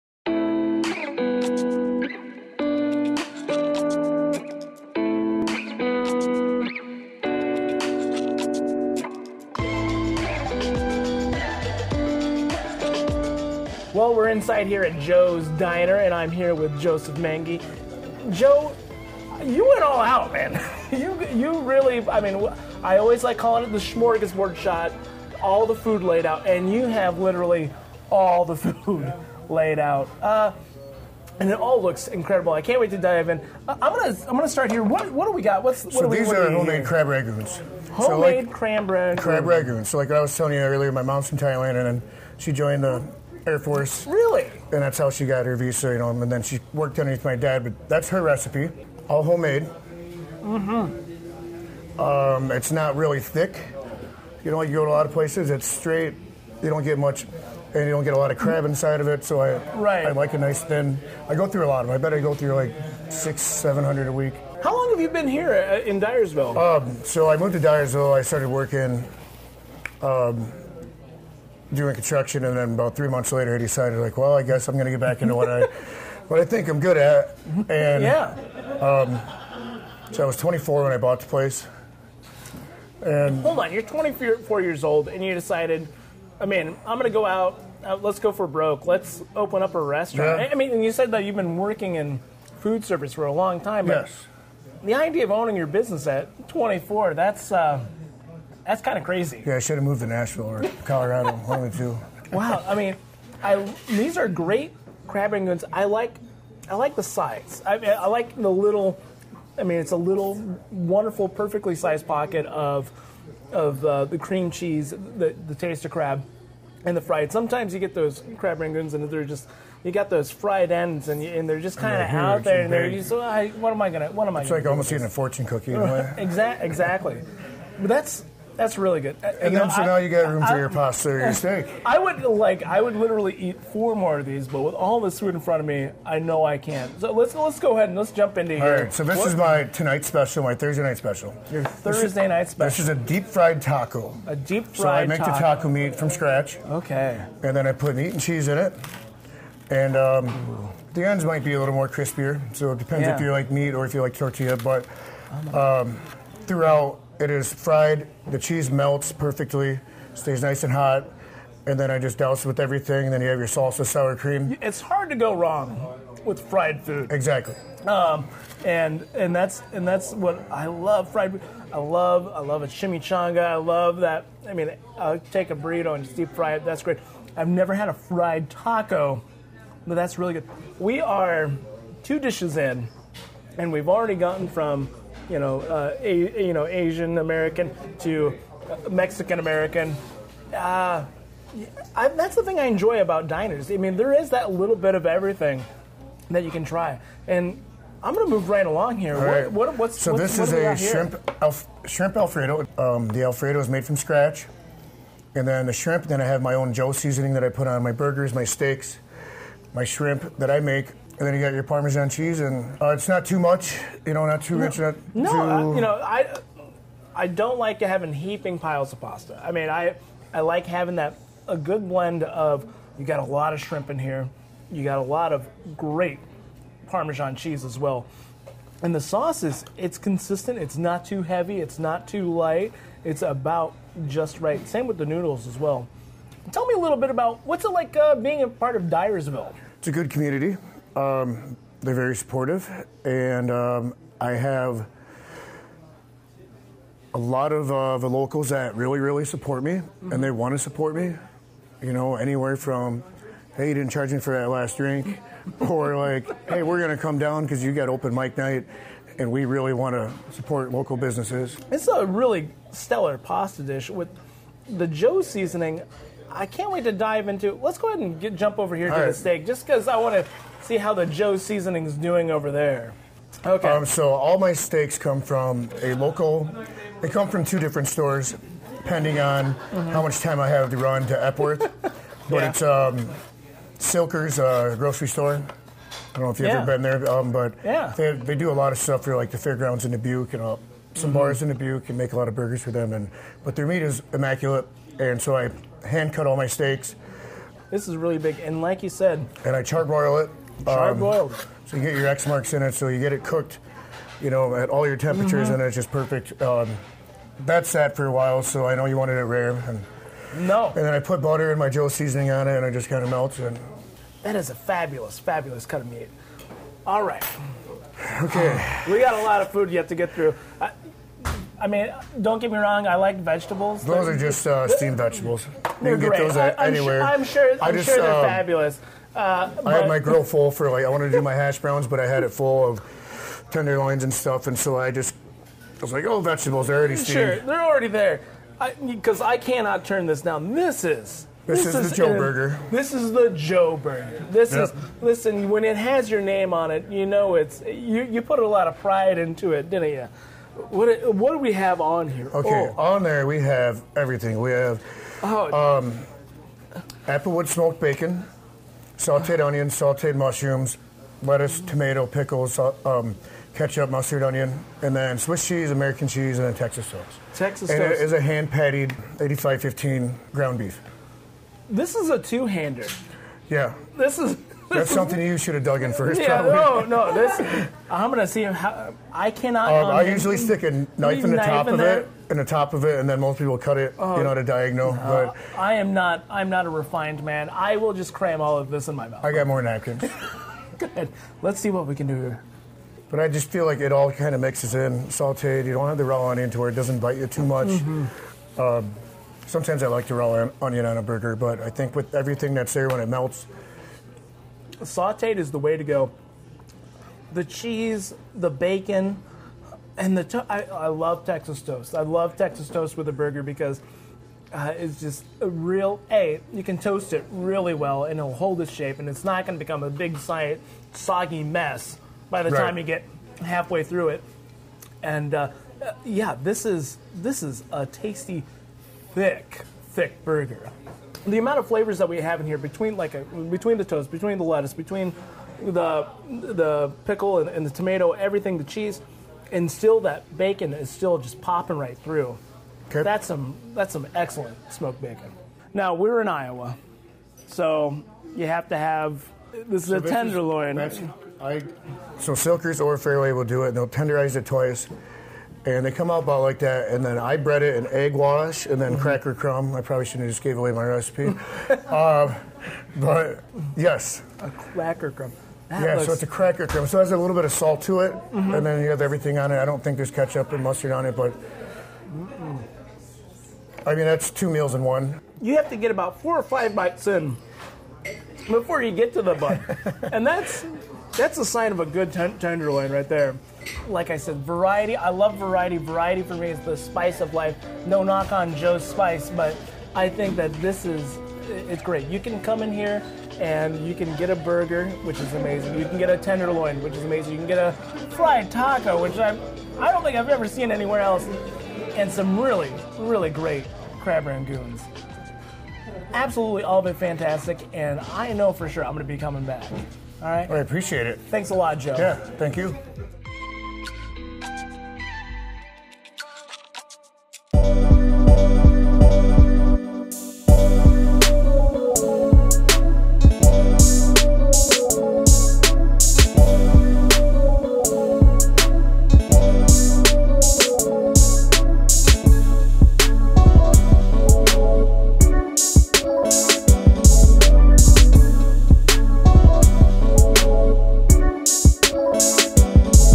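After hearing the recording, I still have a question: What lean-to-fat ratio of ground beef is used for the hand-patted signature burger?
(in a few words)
85/15.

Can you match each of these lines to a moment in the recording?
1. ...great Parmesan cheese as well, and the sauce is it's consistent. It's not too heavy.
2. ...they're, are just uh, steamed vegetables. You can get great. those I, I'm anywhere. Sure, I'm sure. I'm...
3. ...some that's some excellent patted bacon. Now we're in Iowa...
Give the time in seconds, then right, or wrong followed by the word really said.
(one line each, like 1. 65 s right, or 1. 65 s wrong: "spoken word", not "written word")
1. 225 s right
2. 324 s right
3. 443 s wrong: "smoked", not "patted".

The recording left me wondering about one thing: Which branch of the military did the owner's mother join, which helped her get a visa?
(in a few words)
Air Force.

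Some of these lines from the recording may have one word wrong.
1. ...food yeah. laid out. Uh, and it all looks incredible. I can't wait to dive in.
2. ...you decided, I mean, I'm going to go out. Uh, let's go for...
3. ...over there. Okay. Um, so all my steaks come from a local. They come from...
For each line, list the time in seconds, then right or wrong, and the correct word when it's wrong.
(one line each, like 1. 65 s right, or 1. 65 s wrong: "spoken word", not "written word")
1. 28 s right
2. 85 s right
3. 272 s right.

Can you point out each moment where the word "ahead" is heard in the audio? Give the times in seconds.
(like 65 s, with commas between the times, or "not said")
137 s, 267 s.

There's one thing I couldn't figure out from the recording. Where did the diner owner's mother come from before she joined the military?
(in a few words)
Thailand.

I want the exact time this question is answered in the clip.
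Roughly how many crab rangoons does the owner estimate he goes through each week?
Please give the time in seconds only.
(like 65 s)
63 s.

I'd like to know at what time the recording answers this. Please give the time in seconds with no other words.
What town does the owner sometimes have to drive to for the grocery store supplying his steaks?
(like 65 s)
281 s.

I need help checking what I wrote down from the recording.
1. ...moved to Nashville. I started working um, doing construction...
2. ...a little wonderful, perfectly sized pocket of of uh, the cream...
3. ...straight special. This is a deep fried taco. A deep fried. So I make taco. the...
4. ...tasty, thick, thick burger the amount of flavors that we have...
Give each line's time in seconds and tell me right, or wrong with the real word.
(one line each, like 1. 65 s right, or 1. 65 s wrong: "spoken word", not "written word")
1. 67 s wrong: "Dyersville", not "Nashville"
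2. 109 s right
3. 142 s wrong: "night", not "straight"
4. 427 s right.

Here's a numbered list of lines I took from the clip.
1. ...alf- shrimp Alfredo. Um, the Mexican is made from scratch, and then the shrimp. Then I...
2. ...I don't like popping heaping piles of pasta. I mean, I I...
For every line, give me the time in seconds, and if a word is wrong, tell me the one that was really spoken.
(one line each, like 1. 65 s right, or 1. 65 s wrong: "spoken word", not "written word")
1. 201 s wrong: "Alfredo", not "Mexican"
2. 217 s wrong: "having", not "popping".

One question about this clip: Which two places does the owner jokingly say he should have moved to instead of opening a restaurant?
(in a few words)
Nashville or Colorado.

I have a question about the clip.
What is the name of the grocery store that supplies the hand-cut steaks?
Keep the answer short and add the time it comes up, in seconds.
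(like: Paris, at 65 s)
Silker's, at 283 s.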